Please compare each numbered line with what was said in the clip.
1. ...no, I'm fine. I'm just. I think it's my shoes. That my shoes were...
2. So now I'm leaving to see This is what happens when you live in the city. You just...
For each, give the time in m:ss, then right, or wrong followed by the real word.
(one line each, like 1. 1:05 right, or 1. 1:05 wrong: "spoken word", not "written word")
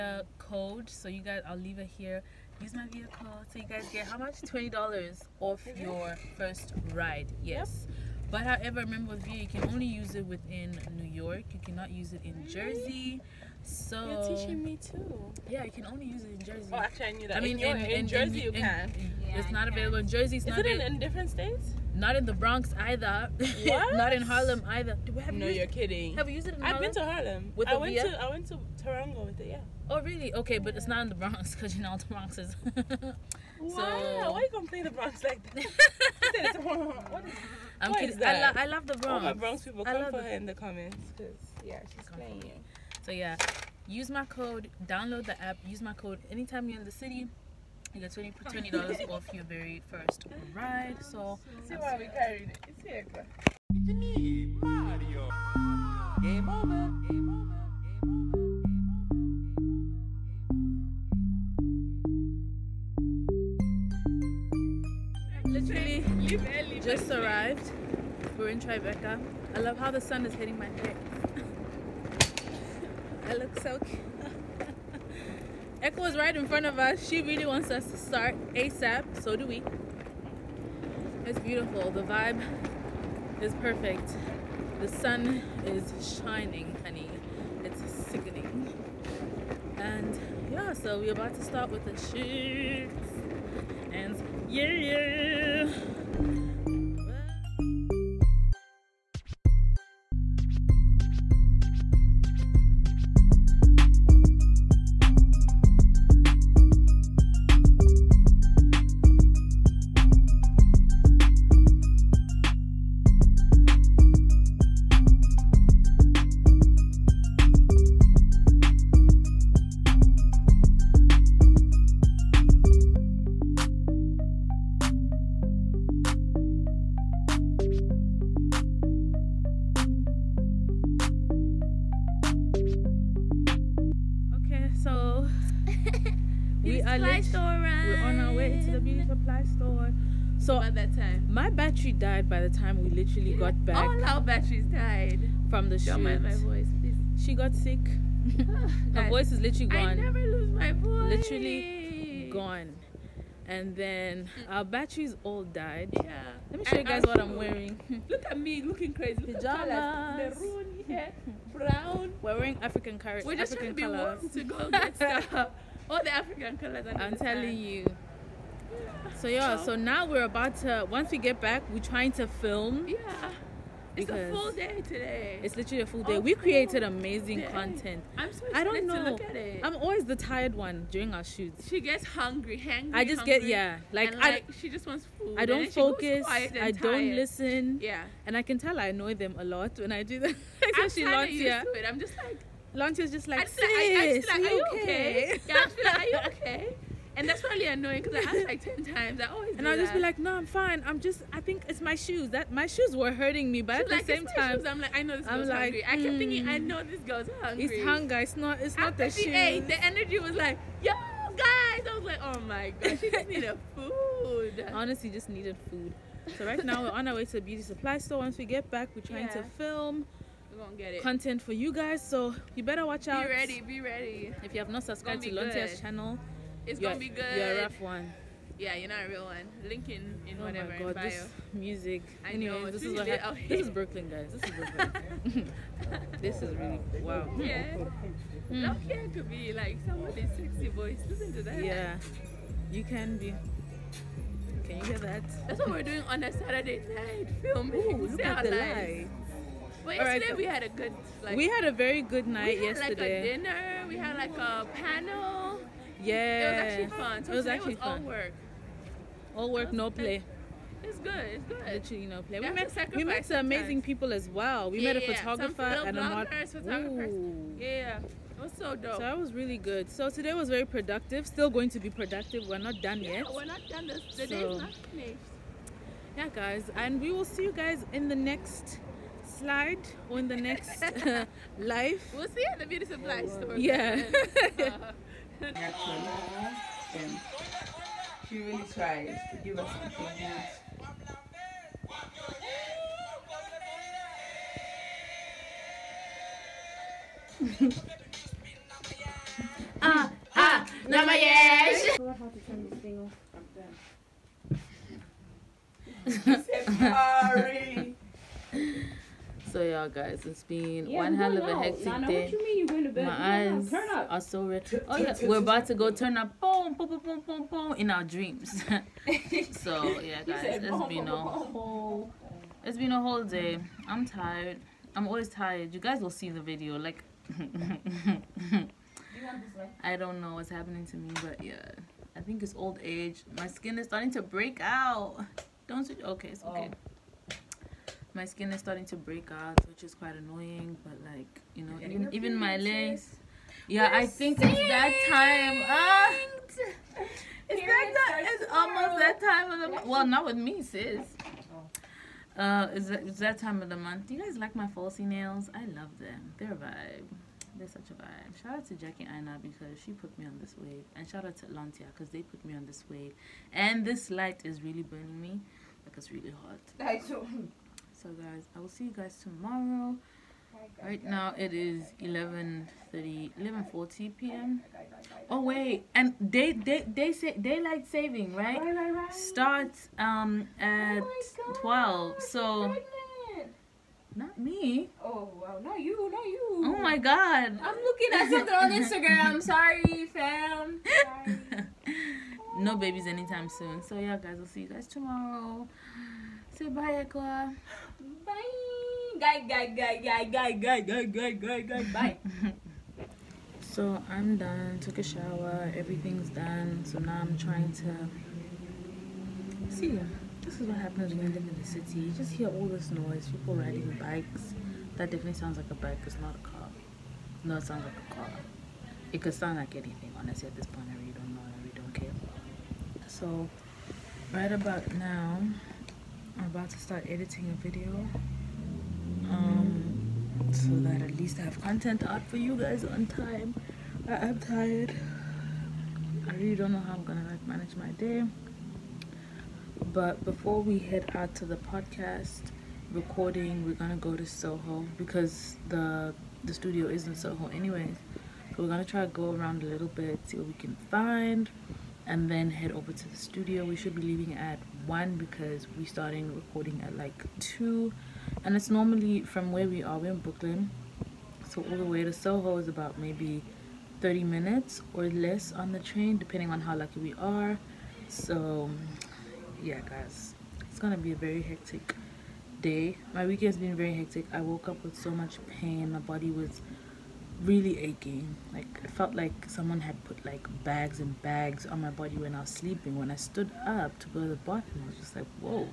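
1. 3:20 right
2. 6:46 wrong: "trying", not "leaving".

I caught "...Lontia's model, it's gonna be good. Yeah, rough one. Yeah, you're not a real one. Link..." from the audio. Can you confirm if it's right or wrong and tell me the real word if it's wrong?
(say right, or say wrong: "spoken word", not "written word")
wrong: "channel", not "model".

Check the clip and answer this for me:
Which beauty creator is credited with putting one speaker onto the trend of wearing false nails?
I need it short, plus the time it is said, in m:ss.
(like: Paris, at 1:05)
Jackie Aina, at 5:58.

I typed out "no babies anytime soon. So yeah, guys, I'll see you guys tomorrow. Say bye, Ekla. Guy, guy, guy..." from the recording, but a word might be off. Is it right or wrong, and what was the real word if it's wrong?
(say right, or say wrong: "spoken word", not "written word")
right.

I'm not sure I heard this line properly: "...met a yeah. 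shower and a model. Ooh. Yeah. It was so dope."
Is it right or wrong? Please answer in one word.
wrong.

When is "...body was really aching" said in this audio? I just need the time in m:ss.
7:55.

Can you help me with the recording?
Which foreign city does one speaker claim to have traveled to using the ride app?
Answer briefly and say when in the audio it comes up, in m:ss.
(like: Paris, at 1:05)
Toronto, at 0:28.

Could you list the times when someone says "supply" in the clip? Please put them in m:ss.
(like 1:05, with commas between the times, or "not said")
2:19, 3:37, 4:42.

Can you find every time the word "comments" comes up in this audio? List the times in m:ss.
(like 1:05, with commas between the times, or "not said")
0:40.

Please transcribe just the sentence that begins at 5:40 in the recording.
But like you know, even even my legs.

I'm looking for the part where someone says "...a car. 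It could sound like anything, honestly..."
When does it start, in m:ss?
6:57.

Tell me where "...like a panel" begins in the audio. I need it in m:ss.
4:14.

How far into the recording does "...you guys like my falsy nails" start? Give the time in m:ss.
5:54.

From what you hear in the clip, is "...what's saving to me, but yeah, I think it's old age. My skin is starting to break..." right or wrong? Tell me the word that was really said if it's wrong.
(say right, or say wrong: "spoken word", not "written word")
wrong: "happening", not "saving".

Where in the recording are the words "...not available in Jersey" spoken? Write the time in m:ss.
0:19.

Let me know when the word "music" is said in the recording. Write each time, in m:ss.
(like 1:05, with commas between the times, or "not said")
3:51.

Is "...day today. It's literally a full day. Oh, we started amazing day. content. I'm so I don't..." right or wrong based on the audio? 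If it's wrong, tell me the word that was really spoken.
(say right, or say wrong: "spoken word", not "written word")
wrong: "created", not "started".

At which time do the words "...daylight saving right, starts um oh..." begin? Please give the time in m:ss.
6:17.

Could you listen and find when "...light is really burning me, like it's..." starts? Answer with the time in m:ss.
6:04.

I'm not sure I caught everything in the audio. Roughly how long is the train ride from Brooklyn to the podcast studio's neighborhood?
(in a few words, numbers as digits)
30 minutes.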